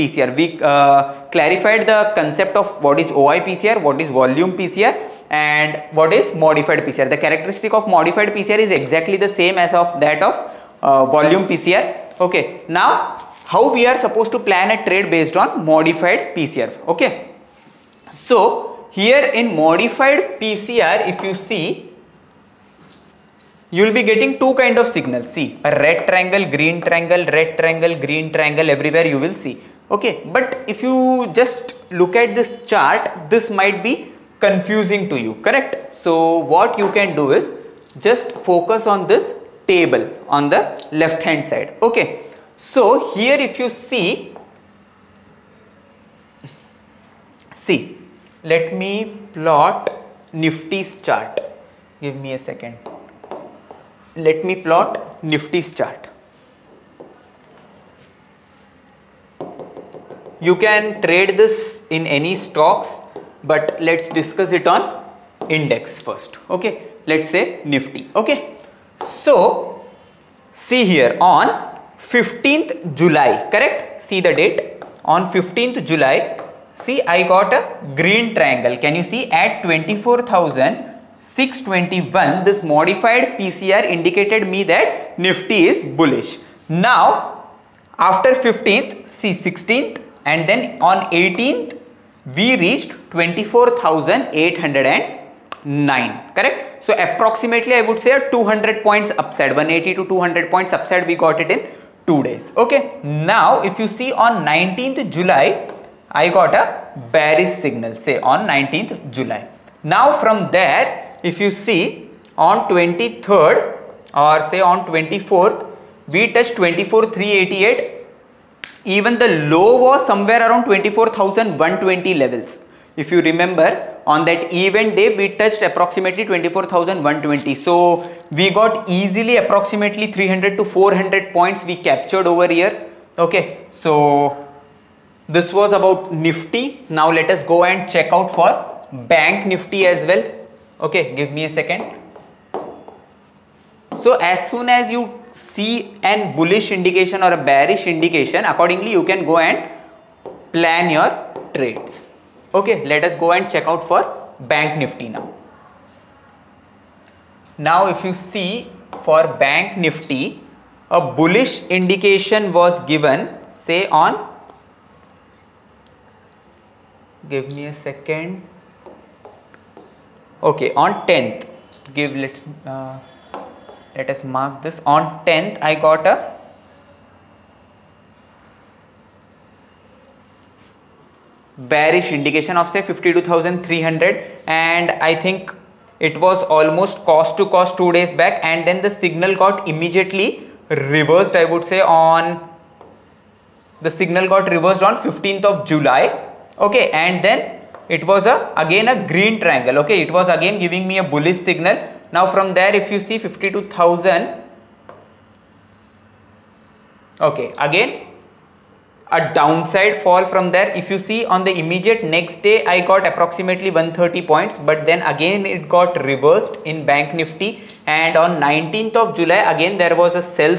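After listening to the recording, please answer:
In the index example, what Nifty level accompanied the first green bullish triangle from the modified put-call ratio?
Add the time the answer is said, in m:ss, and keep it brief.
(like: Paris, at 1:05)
24,621, at 1:19.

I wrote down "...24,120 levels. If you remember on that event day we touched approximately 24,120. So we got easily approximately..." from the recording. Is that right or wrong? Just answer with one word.
right.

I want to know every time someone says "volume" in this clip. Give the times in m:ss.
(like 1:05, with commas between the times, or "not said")
0:04, 0:11.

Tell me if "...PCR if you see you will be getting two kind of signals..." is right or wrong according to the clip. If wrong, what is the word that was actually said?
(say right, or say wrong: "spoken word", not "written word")
right.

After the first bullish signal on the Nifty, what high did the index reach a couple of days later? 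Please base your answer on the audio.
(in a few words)
24,809.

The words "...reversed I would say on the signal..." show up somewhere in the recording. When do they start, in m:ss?
3:10.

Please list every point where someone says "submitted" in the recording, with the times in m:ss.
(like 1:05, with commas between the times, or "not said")
not said.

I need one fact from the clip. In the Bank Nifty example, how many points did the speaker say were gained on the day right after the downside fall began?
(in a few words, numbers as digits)
130.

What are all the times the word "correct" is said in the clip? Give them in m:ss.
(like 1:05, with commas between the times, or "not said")
0:35, 1:13, 1:36.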